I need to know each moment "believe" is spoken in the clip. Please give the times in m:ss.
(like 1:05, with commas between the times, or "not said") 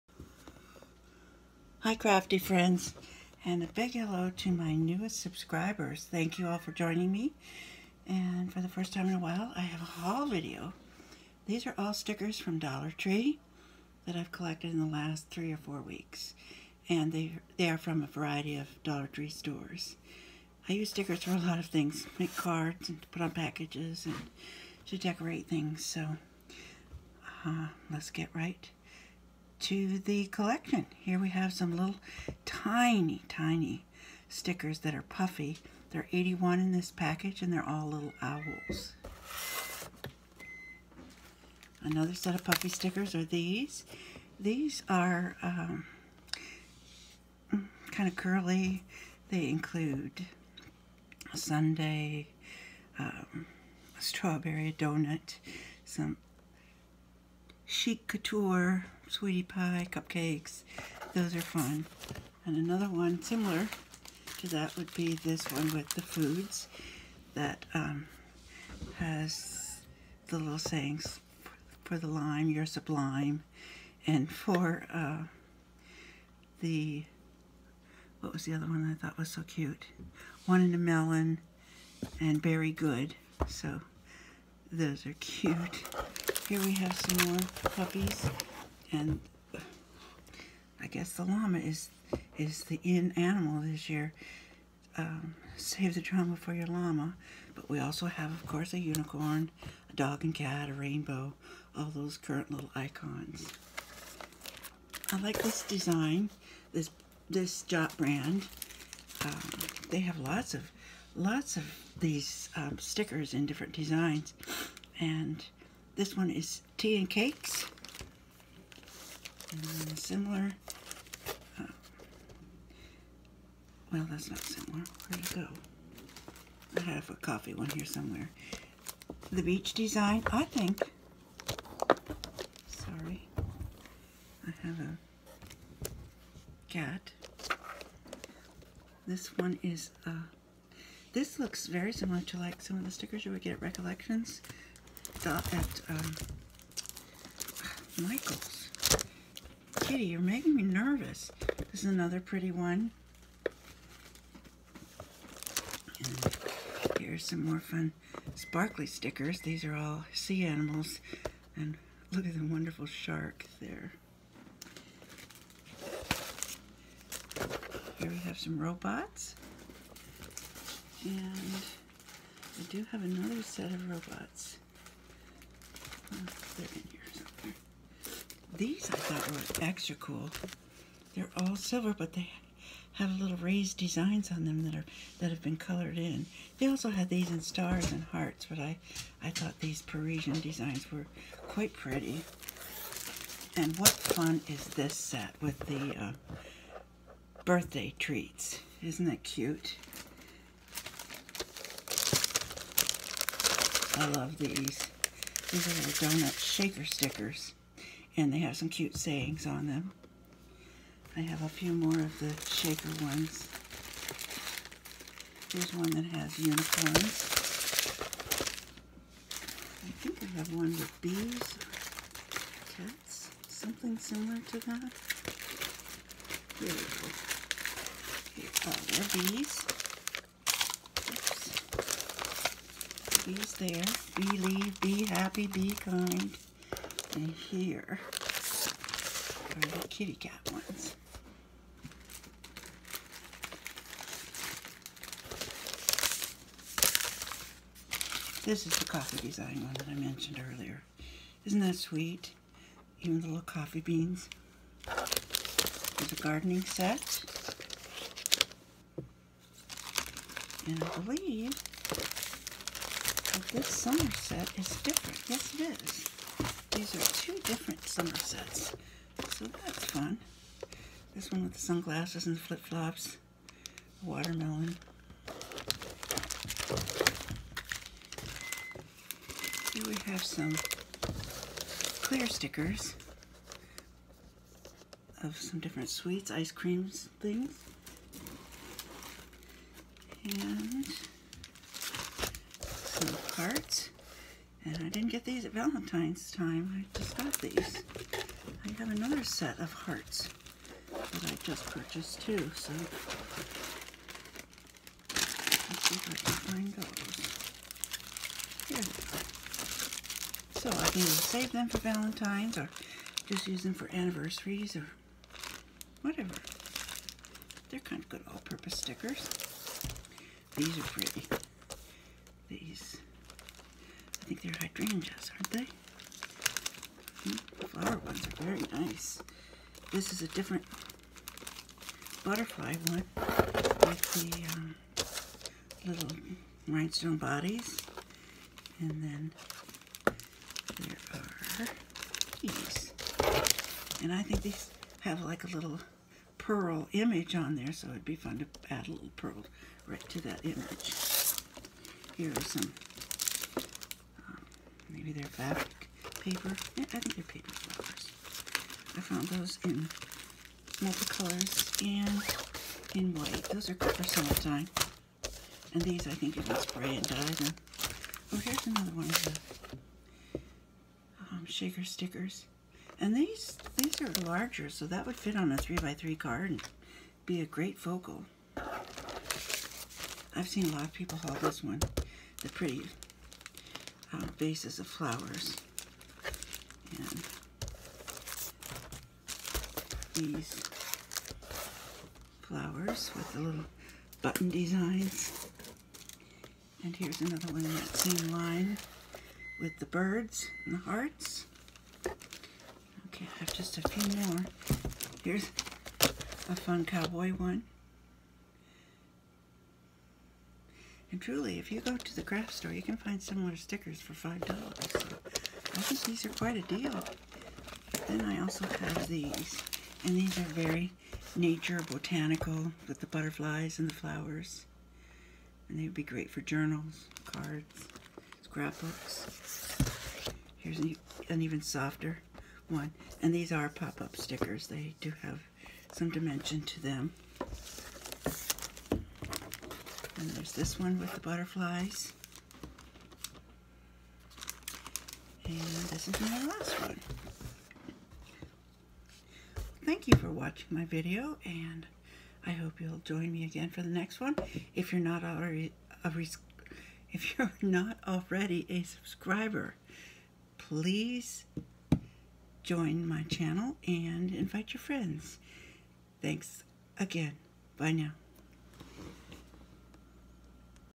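3:54, 4:20.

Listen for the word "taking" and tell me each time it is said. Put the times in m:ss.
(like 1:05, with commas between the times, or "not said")
not said.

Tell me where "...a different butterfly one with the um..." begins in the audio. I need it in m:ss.
5:30.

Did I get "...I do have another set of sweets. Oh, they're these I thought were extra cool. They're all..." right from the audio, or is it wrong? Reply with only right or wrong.
wrong.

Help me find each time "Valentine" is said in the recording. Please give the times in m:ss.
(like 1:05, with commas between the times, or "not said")
4:55, 5:11.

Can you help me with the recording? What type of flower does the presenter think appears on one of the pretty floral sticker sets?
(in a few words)
hydrangeas.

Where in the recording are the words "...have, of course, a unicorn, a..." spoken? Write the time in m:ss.
1:38.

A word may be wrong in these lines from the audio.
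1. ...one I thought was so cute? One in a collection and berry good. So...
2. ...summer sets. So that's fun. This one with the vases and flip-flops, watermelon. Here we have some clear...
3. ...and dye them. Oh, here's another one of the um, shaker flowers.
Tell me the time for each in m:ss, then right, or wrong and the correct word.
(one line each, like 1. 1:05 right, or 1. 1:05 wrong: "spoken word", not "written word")
1. 1:18 wrong: "melon", not "collection"
2. 4:27 wrong: "sunglasses", not "vases"
3. 6:06 wrong: "stickers", not "flowers".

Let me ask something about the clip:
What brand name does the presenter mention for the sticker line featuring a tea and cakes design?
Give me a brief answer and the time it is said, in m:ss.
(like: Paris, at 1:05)
Jot, at 1:47.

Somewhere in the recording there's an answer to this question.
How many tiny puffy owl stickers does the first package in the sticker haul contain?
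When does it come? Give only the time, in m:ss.
0:36.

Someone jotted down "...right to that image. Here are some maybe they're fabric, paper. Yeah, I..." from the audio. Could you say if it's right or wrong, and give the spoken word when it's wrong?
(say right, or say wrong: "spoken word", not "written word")
right.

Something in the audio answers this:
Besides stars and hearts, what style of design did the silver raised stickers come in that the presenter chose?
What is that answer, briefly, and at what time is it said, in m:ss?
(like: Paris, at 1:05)
Parisian, at 3:09.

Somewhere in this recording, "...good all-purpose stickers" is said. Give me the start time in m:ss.
5:18.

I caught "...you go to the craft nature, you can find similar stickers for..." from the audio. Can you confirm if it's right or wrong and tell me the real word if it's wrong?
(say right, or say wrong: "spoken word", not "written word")
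wrong: "store", not "nature".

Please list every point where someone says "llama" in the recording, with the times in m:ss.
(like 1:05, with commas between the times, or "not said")
1:31, 1:36.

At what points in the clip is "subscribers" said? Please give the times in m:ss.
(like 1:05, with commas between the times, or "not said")
0:05, 7:38.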